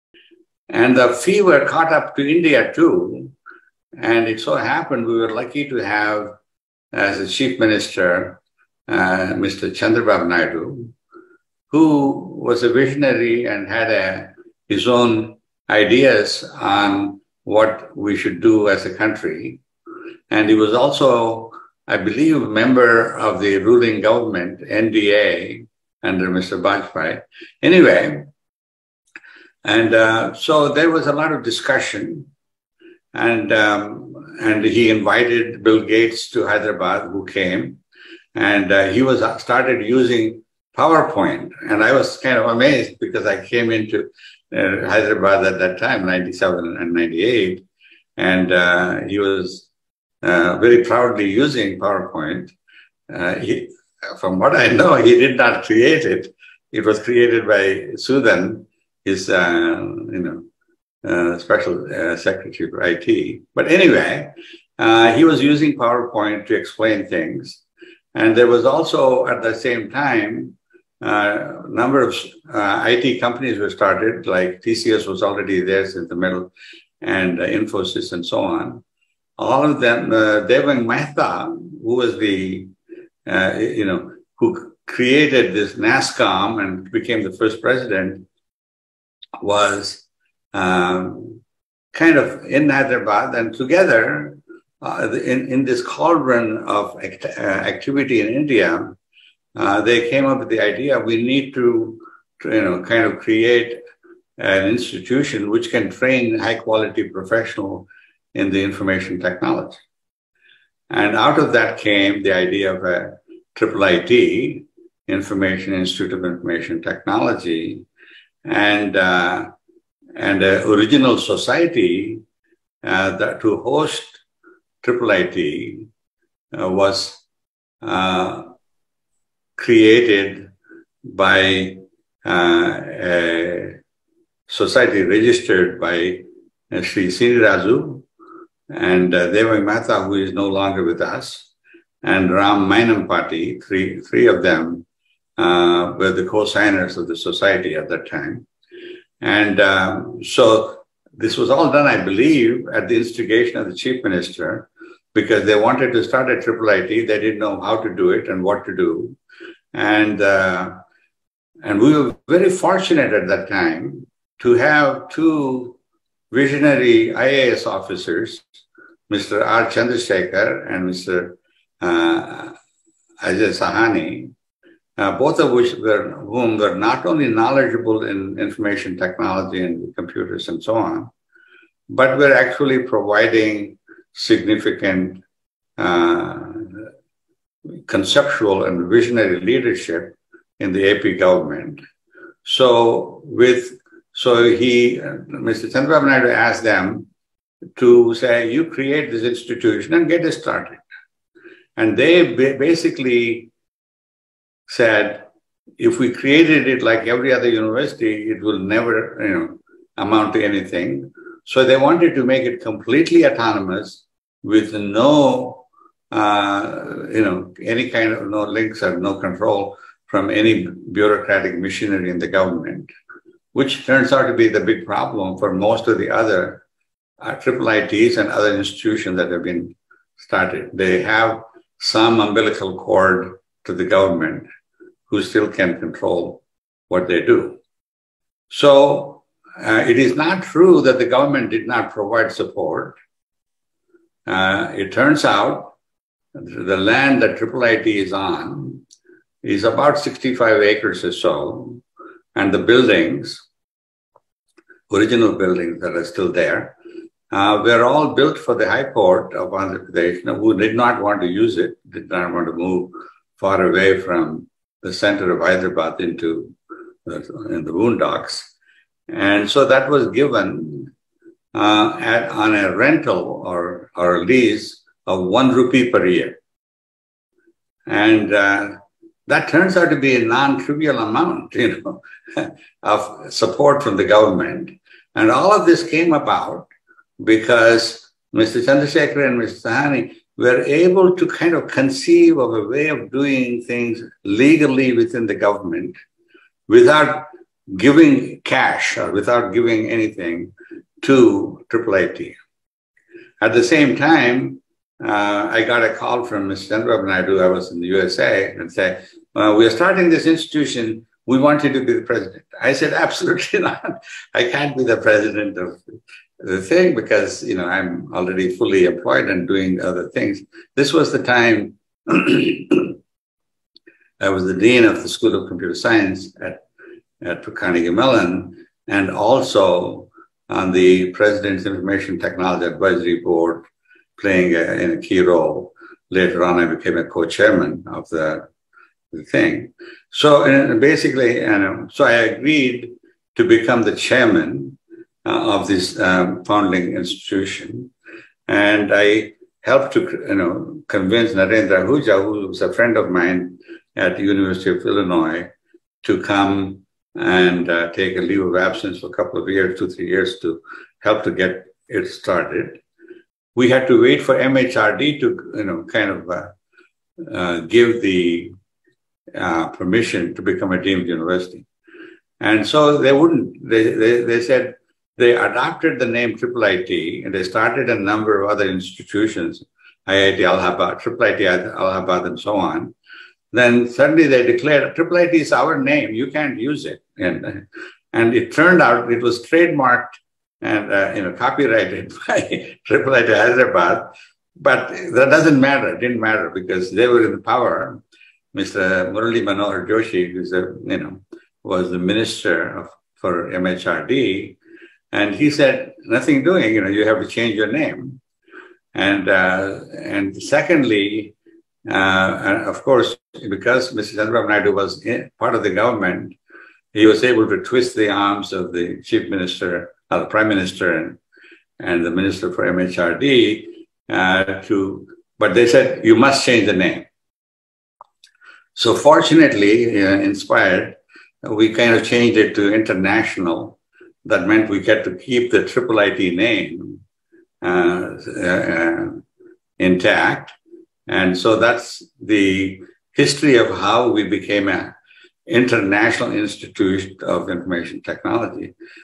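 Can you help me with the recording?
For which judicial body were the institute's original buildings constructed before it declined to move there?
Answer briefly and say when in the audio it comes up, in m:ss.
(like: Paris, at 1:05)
High Court of Andhra Pradesh, at 4:18.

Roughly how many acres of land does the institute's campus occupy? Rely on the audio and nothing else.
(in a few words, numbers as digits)
65 acres.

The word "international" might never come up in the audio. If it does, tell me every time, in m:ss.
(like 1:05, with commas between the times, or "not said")
7:12, 7:25.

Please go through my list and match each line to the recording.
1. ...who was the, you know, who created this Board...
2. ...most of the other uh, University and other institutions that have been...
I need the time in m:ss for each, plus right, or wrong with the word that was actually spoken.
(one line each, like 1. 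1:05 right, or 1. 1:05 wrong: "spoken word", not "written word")
1. 1:21 wrong: "NASSCOM", not "Board"
2. 3:45 wrong: "IIITs", not "University".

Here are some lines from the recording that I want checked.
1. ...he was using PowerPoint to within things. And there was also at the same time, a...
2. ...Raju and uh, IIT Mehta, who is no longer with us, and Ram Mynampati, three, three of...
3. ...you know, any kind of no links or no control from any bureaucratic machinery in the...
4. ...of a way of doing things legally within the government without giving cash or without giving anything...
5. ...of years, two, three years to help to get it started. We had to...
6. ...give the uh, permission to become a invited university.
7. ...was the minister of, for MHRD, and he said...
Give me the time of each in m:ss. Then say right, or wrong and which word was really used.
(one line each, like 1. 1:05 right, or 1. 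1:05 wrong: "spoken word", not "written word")
1. 1:05 wrong: "explain", not "within"
2. 2:17 wrong: "Devang", not "IIT"
3. 3:37 right
4. 4:52 right
5. 5:59 right
6. 6:07 wrong: "deemed", not "invited"
7. 6:41 right.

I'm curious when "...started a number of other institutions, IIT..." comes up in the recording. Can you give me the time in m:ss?
6:17.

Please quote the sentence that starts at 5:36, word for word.
Later on, I became a co-chairman of the, the thing.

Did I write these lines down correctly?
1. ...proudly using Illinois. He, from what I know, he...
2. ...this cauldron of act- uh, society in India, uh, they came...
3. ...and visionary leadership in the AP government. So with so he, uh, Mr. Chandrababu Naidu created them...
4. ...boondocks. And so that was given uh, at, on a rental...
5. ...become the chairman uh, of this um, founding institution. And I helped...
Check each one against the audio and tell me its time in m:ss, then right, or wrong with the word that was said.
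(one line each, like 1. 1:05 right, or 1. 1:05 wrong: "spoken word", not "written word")
1. 0:50 wrong: "PowerPoint", not "Illinois"
2. 1:35 wrong: "activity", not "society"
3. 3:08 wrong: "asked", not "created"
4. 4:27 right
5. 5:43 right.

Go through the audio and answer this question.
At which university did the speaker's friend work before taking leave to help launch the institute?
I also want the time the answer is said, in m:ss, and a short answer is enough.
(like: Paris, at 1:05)
University of Illinois, at 5:54.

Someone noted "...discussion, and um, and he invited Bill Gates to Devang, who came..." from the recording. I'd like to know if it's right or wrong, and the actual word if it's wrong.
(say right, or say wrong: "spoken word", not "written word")
wrong: "Hyderabad", not "Devang".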